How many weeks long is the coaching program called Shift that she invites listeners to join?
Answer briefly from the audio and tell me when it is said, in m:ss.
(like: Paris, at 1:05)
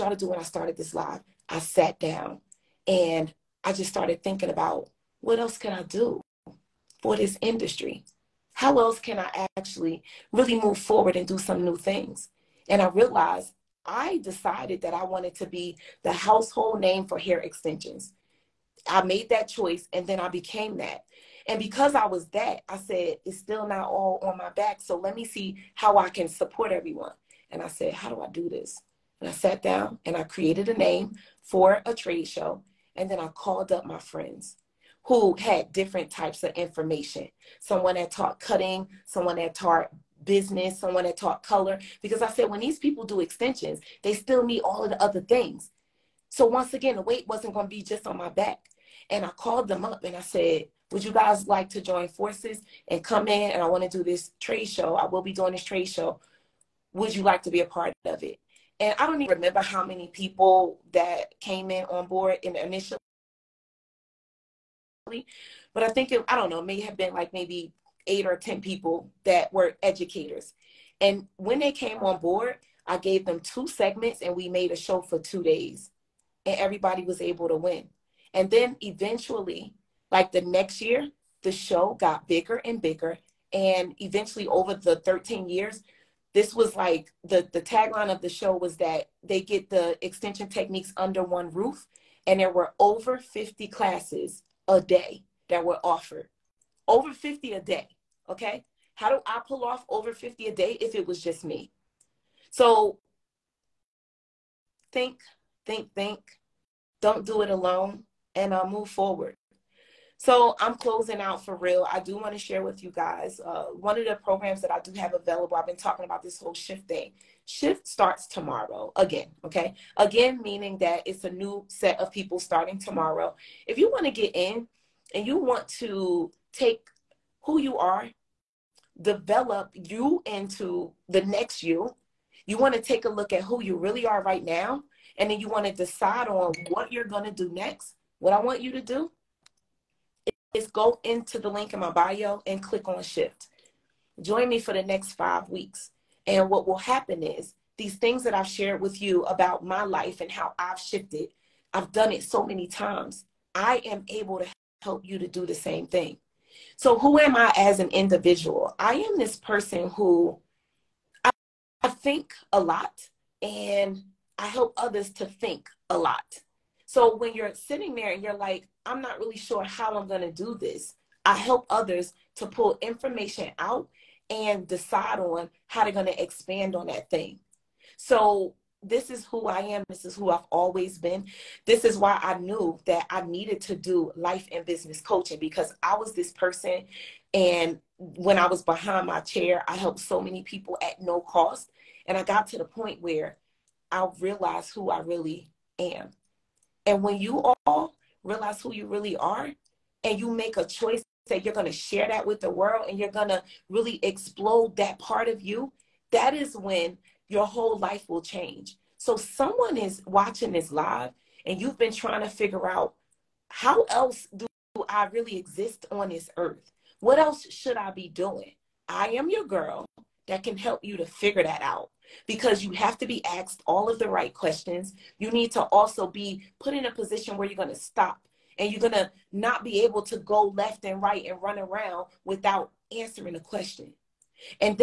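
5, at 2:25.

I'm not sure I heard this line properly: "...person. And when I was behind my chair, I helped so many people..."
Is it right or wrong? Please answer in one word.
right.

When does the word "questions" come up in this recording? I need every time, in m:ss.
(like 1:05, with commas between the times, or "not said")
3:44, 3:53.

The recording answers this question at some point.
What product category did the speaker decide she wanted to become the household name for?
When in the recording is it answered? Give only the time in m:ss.
0:17.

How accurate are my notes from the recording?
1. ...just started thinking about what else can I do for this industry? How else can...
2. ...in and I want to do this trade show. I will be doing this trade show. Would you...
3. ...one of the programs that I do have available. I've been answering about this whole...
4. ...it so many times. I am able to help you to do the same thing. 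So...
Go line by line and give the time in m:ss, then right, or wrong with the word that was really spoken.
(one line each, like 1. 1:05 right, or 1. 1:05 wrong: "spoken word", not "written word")
1. 0:03 right
2. 0:53 right
3. 1:53 wrong: "talking", not "answering"
4. 2:32 right.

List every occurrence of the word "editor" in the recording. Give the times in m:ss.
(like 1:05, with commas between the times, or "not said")
not said.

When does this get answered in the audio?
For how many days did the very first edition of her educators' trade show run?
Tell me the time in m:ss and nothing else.
1:15.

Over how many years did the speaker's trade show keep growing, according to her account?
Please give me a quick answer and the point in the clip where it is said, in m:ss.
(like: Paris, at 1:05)
13, at 1:24.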